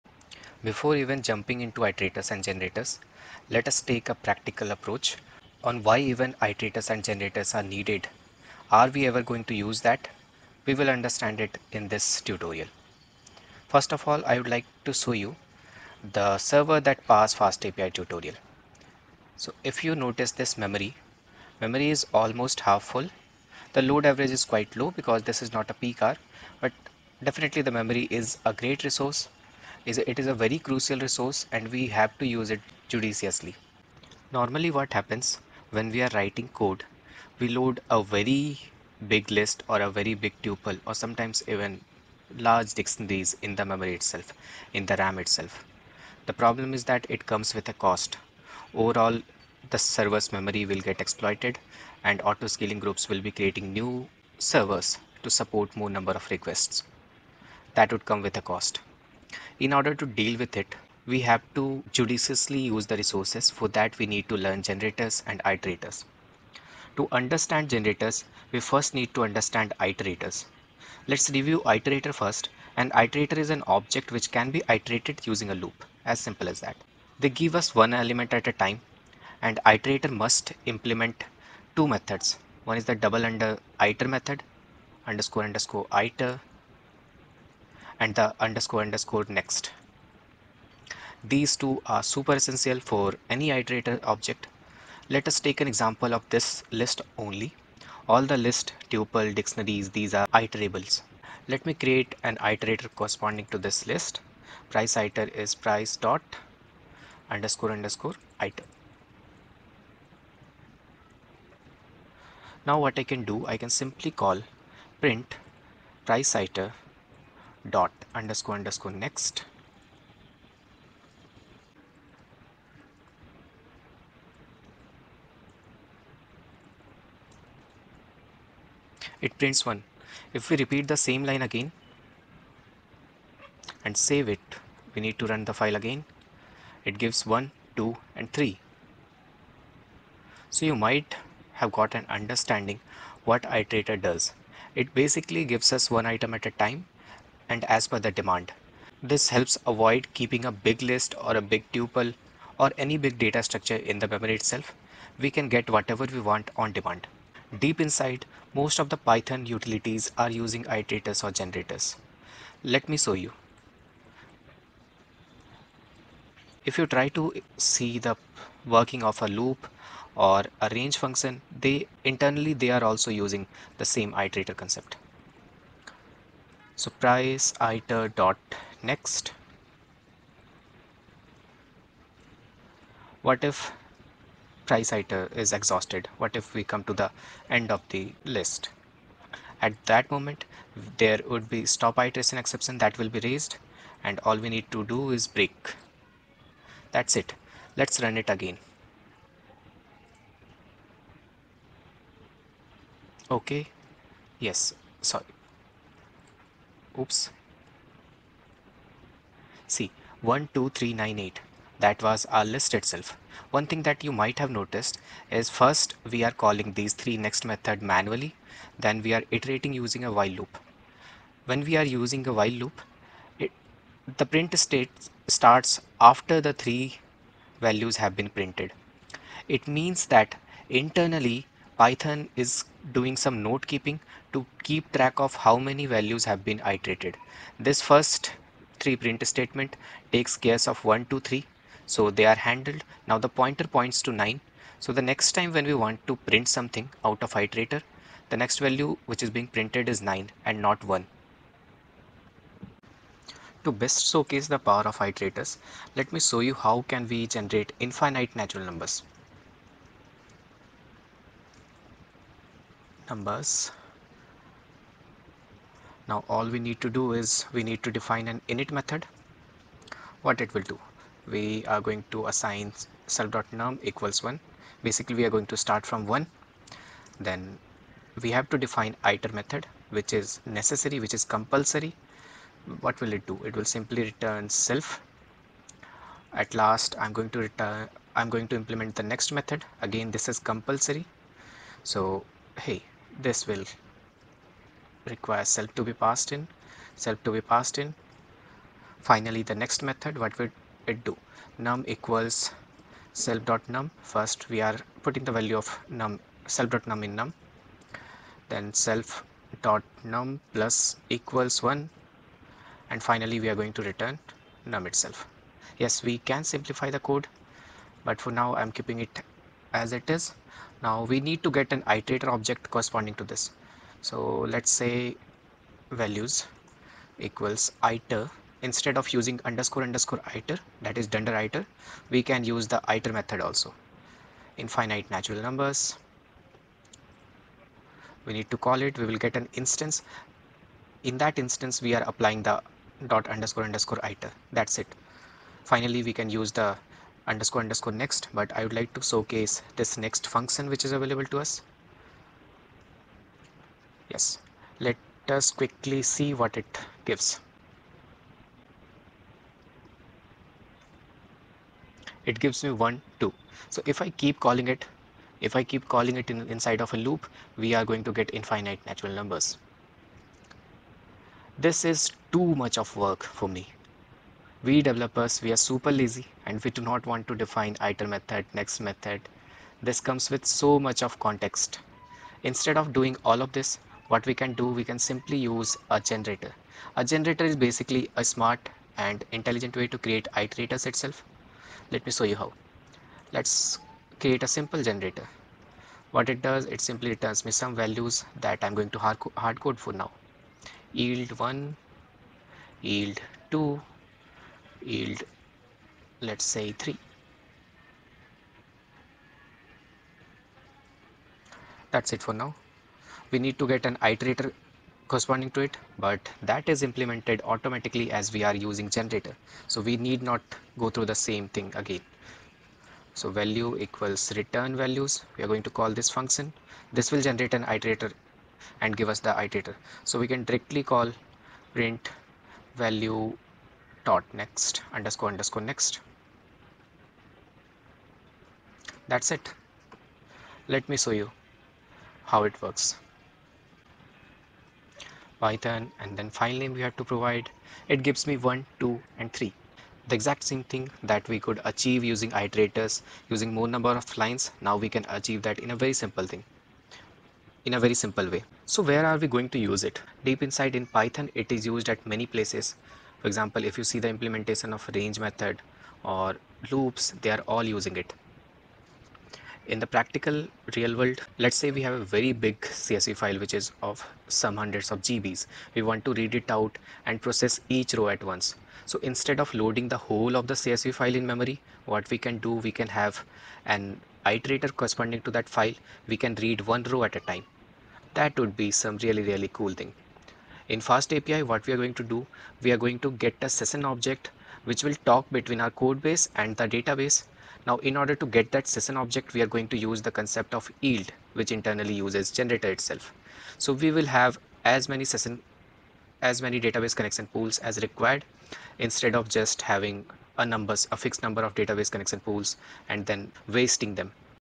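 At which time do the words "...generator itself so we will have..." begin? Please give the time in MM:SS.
08:22.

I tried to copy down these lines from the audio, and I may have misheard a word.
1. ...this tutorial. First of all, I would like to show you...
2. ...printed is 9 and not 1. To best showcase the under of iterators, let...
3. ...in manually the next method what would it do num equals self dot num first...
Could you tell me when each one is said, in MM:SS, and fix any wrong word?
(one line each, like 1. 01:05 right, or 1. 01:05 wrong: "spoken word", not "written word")
1. 00:11 right
2. 04:09 wrong: "power", not "under"
3. 04:57 wrong: "finally", not "manually".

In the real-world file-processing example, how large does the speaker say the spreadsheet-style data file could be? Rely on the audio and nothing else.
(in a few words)
Hundreds of GBs.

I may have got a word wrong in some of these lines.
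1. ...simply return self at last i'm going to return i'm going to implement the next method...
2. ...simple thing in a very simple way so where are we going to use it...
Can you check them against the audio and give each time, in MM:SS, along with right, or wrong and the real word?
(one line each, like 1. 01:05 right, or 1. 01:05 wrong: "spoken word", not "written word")
1. 04:43 right
2. 07:36 right.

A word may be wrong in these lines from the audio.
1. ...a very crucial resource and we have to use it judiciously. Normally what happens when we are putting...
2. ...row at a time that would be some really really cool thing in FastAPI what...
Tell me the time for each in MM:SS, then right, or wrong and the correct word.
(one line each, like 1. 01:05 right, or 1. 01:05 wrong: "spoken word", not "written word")
1. 00:30 wrong: "writing", not "putting"
2. 08:06 right.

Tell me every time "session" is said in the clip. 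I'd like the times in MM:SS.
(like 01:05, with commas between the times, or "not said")
08:13, 08:18, 08:25.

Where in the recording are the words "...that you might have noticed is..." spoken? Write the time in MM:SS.
03:33.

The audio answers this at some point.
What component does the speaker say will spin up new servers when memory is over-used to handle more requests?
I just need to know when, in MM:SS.
00:52.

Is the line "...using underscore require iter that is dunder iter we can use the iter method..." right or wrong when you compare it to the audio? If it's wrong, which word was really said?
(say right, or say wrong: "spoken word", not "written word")
wrong: "underscore", not "require".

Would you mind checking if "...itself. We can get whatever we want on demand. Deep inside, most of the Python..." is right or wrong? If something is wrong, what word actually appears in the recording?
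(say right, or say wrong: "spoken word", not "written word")
right.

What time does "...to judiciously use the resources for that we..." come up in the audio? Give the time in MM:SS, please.
01:01.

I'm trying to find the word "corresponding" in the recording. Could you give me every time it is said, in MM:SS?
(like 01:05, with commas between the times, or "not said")
01:42, 05:22, 06:55, 08:04.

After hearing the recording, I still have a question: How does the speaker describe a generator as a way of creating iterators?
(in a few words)
A smart and intelligent way.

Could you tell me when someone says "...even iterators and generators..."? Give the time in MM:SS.
00:05.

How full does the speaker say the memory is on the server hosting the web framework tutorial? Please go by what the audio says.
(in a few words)
Almost half full.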